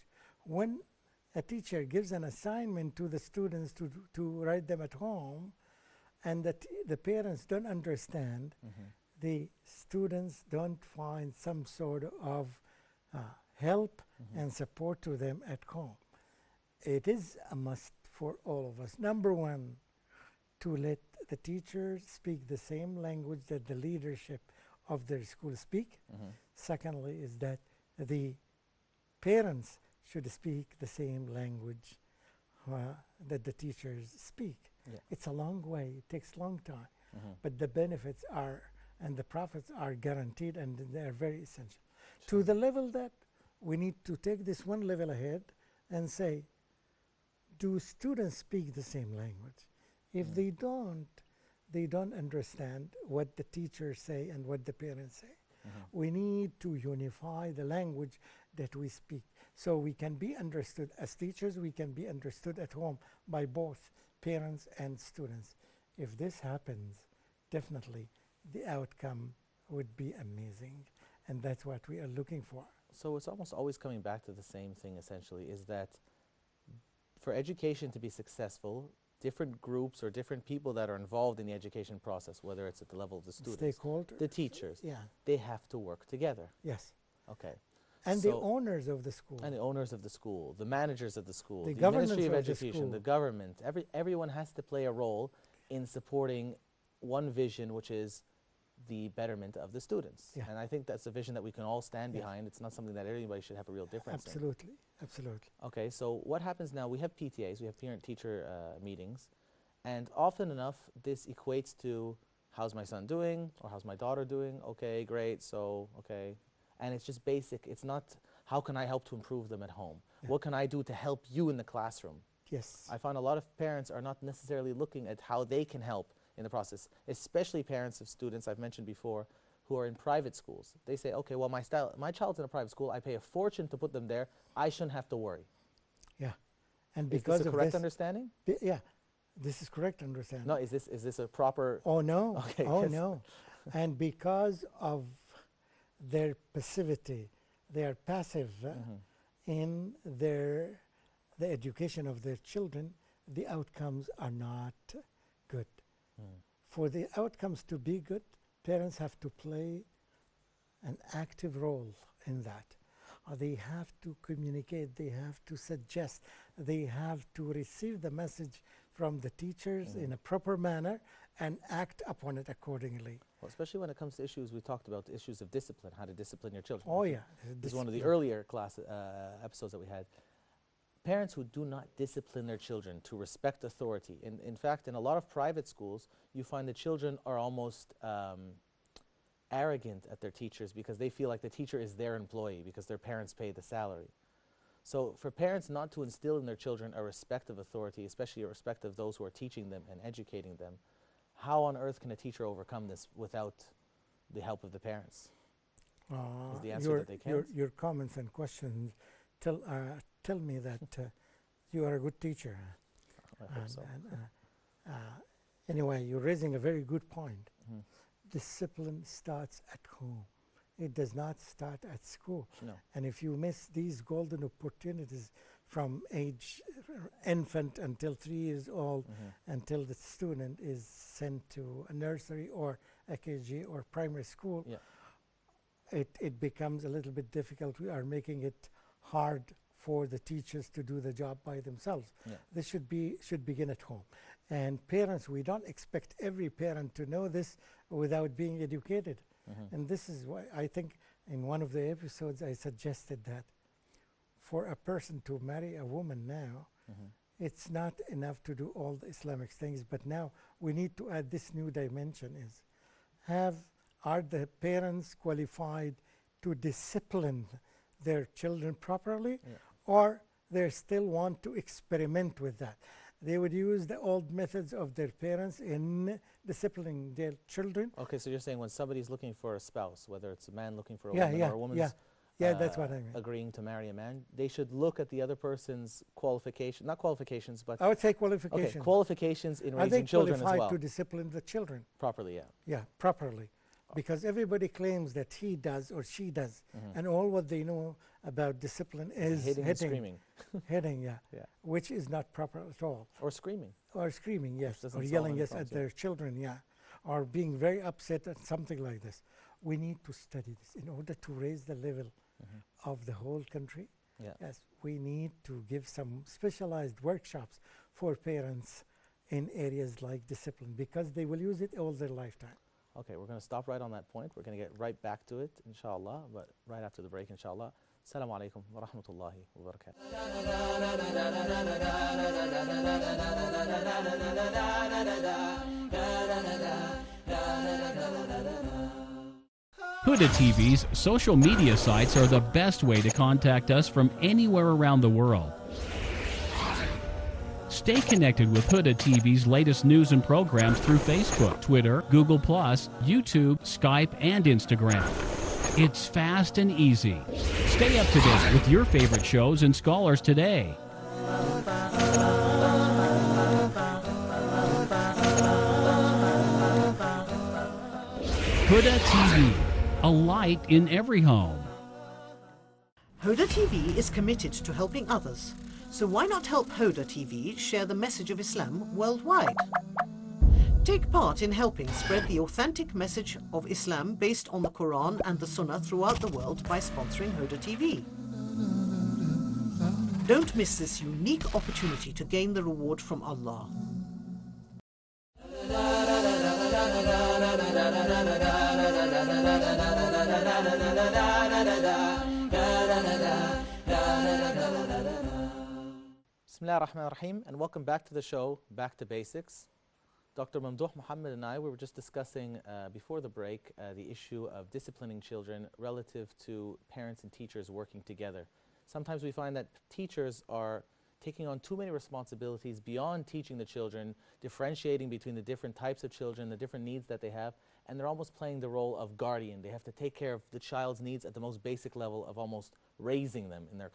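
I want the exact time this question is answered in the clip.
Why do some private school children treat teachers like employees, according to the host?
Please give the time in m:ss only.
3:12.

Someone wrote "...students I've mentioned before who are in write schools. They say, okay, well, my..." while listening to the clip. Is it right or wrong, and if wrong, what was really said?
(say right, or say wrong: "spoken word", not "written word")
wrong: "private", not "write".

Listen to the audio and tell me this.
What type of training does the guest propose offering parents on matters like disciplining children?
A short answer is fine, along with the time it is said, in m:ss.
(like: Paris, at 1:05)
Specialized workshops, at 5:16.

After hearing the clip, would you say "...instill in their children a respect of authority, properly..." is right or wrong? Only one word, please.
wrong.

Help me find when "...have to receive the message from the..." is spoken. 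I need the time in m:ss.
2:46.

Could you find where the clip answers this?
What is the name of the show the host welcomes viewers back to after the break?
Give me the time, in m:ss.
6:48.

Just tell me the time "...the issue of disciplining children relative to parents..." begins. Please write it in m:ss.
6:53.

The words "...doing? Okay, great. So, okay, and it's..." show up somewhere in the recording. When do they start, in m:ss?
1:54.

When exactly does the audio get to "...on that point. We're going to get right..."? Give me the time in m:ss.
5:23.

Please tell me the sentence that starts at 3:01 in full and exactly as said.
Parents who do not discipline their children to respect authority.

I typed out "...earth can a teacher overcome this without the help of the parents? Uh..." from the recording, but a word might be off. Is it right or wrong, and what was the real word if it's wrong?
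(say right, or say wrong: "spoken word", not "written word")
right.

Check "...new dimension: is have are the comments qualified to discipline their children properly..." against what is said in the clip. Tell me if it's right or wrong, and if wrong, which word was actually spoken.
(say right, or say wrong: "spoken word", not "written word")
wrong: "parents", not "comments".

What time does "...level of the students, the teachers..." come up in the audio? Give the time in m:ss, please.
1:22.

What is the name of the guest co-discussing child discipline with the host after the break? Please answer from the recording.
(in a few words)
Dr. Mamdouh Mohamed.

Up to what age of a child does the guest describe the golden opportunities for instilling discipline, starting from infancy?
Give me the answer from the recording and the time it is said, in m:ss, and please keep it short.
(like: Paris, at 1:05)
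3 years old, at 3:48.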